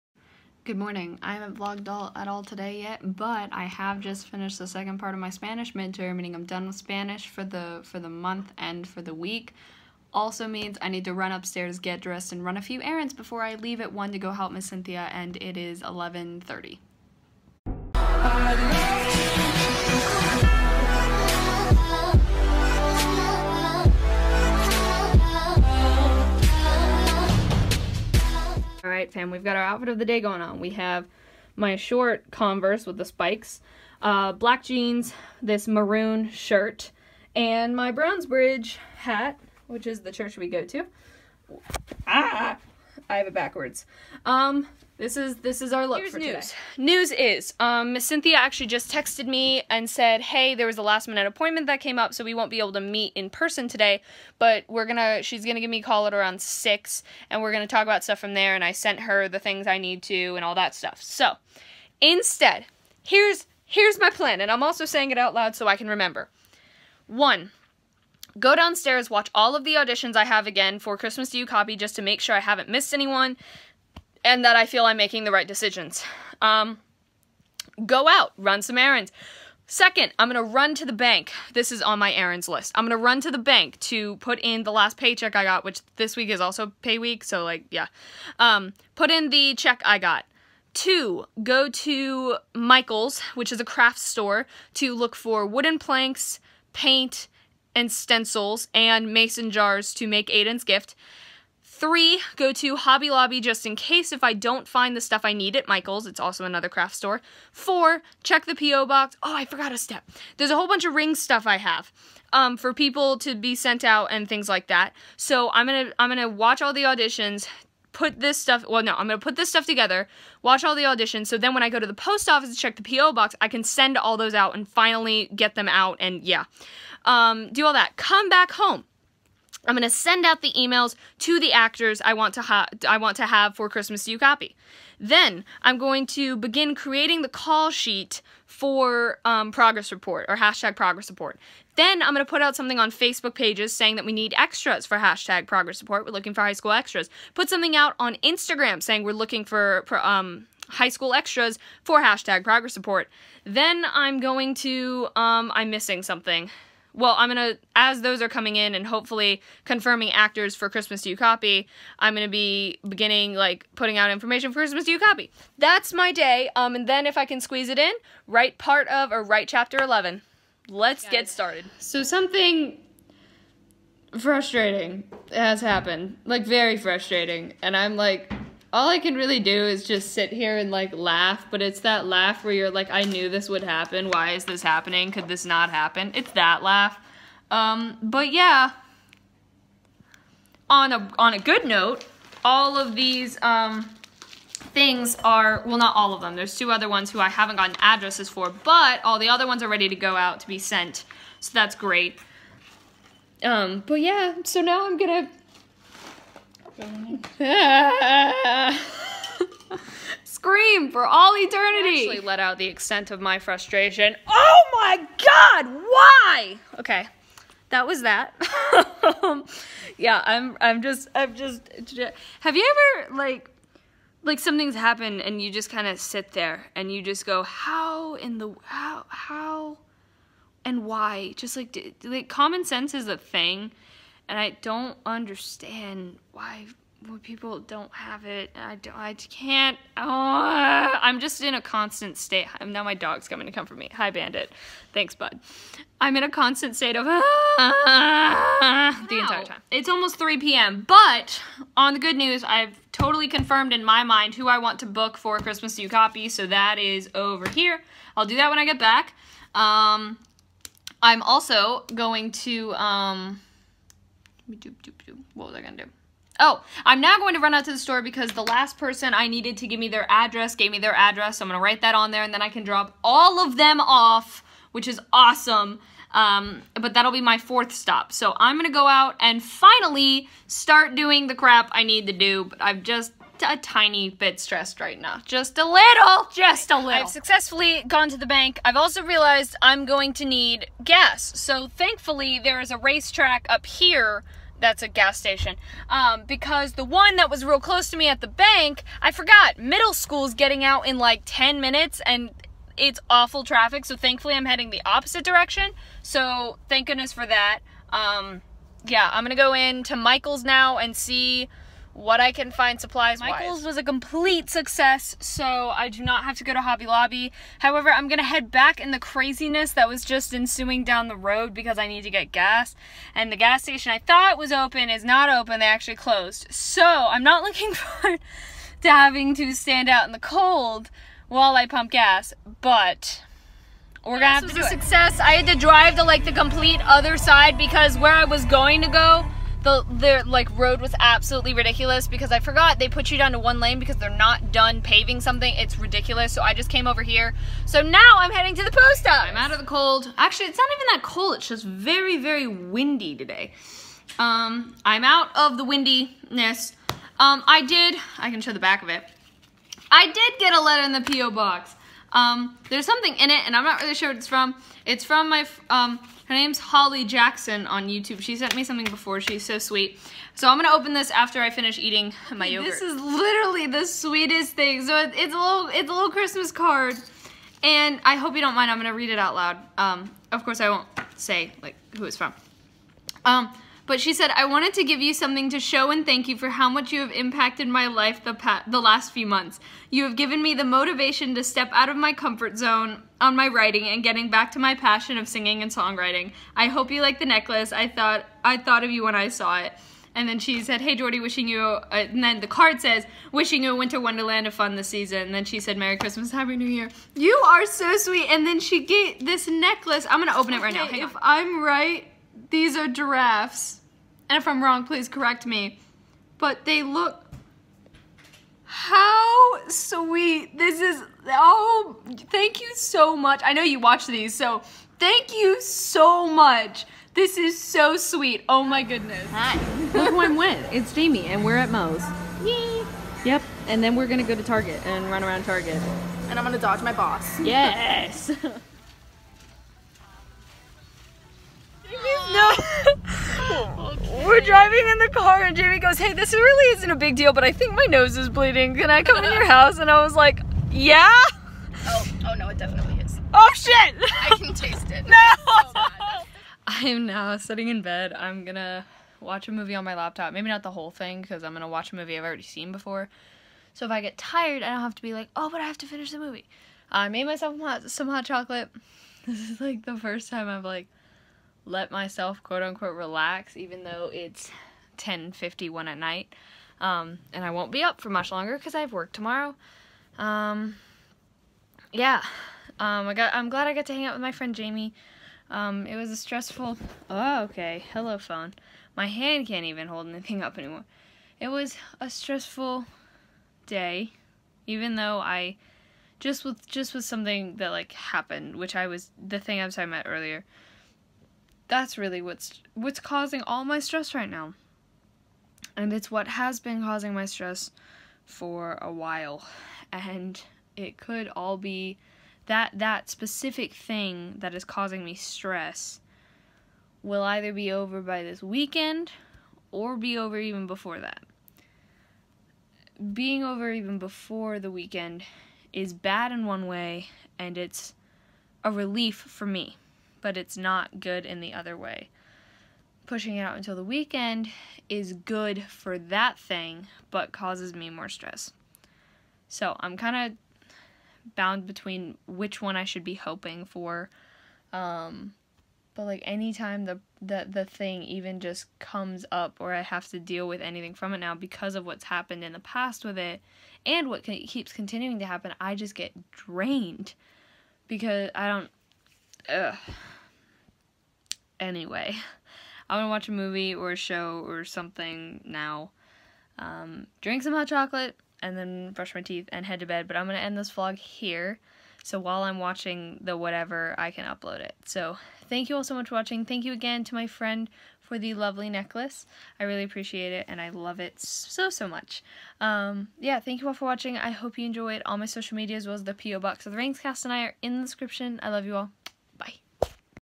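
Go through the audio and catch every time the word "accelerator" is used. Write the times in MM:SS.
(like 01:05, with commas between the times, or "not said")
not said.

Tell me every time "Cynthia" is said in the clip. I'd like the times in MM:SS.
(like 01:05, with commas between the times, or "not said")
00:14, 00:48.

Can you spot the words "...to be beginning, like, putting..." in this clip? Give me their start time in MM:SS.
02:42.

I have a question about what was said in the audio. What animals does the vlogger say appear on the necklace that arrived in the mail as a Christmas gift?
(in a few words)
Giraffes.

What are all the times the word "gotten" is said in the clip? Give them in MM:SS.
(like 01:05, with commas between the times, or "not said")
03:17.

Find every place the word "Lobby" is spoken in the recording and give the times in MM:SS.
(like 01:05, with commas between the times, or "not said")
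01:43, 05:16.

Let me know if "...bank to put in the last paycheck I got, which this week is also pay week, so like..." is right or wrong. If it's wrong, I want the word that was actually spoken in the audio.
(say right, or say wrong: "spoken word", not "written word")
right.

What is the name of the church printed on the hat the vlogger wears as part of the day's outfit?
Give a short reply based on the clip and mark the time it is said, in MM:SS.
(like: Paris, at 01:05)
Browns Bridge, at 00:37.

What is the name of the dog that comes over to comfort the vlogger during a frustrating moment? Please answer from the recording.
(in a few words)
Bandit.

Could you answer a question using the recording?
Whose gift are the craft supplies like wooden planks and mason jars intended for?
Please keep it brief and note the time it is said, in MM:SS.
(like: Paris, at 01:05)
Aiden, at 01:40.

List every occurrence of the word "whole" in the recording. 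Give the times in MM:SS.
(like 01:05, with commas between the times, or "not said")
01:50, 07:40.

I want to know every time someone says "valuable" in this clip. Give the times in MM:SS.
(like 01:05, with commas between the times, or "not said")
not said.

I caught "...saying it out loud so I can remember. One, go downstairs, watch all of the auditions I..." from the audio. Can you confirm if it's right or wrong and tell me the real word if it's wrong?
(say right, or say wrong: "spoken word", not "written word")
right.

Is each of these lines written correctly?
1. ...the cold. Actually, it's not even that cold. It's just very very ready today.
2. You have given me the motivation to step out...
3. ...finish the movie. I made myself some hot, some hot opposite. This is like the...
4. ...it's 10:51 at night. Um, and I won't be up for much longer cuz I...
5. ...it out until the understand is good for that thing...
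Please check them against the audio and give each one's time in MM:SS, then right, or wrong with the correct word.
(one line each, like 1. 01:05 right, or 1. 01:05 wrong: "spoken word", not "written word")
1. 05:49 wrong: "windy", not "ready"
2. 06:29 right
3. 07:45 wrong: "chocolate", not "opposite"
4. 07:54 right
5. 08:53 wrong: "weekend", not "understand".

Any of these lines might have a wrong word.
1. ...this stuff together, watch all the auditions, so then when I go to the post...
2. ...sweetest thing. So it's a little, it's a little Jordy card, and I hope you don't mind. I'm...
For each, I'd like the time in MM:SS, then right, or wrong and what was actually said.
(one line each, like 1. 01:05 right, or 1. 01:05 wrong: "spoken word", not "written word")
1. 01:59 right
2. 06:13 wrong: "Christmas", not "Jordy".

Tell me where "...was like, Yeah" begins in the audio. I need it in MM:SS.
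07:30.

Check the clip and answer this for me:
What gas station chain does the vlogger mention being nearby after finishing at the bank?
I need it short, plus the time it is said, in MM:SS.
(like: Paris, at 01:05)
RaceTrac, at 04:52.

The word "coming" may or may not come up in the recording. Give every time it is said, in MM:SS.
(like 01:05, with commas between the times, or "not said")
02:38, 04:03.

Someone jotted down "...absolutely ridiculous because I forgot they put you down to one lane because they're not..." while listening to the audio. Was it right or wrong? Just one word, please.
right.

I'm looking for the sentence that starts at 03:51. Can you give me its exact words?
Just like like common sense is a thing and I don't understand why when people don't have it.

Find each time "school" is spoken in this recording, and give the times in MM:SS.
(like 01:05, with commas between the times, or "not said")
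02:26, 02:30, 04:59.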